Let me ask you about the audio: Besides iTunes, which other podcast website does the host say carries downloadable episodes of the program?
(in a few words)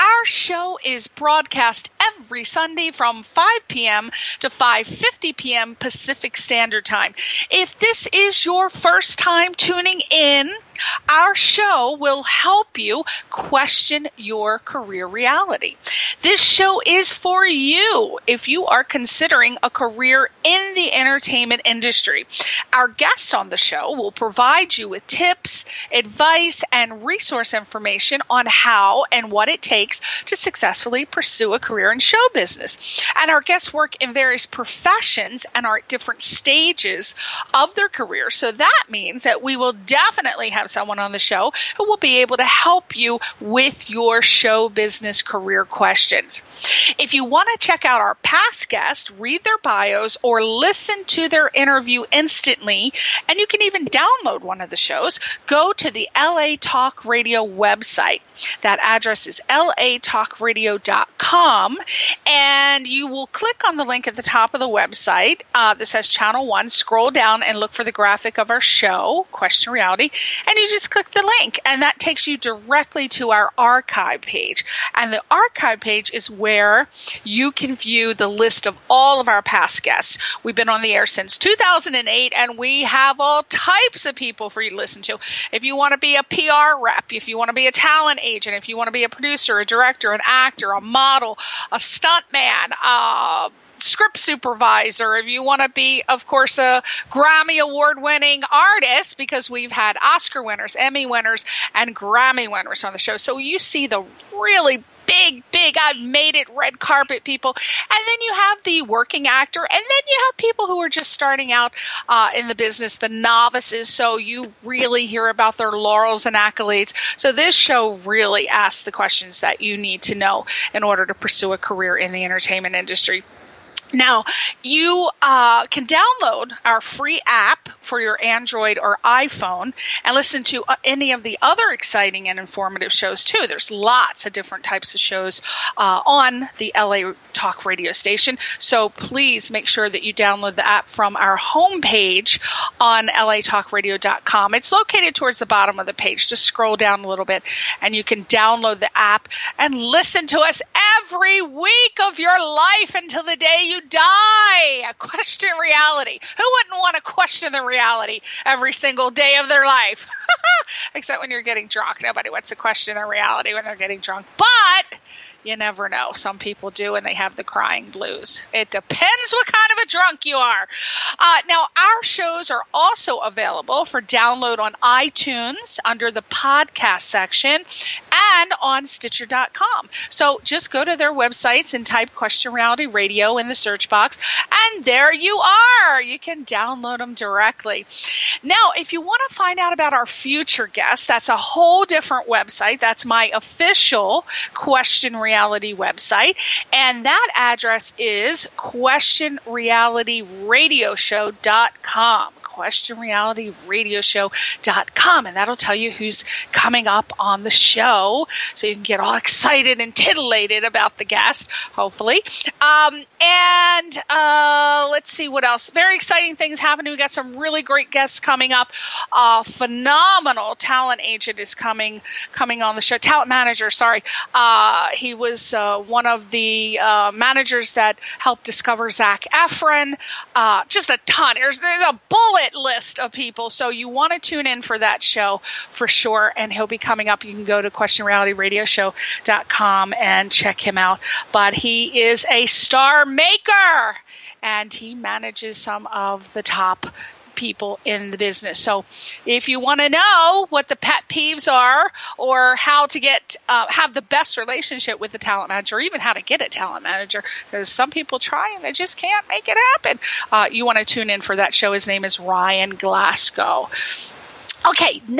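Stitcher.com.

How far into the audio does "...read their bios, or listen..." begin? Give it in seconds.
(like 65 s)
49 s.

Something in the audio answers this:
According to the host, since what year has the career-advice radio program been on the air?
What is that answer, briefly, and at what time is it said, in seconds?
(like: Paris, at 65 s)
2008, at 81 s.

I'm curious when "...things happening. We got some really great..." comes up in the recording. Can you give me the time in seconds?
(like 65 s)
216 s.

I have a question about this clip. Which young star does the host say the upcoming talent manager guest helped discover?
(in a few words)
Zac Efron.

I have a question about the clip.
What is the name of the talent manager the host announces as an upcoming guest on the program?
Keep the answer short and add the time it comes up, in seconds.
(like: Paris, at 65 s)
Ryan Glasgow, at 262 s.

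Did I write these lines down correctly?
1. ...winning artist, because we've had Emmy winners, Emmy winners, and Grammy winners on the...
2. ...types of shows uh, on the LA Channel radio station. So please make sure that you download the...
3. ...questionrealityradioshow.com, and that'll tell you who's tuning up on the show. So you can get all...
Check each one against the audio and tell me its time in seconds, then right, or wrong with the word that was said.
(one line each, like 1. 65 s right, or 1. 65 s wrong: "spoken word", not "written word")
1. 98 s wrong: "Oscar", not "Emmy"
2. 134 s wrong: "Talk", not "Channel"
3. 202 s wrong: "coming", not "tuning".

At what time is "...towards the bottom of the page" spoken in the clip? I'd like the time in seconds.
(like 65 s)
145 s.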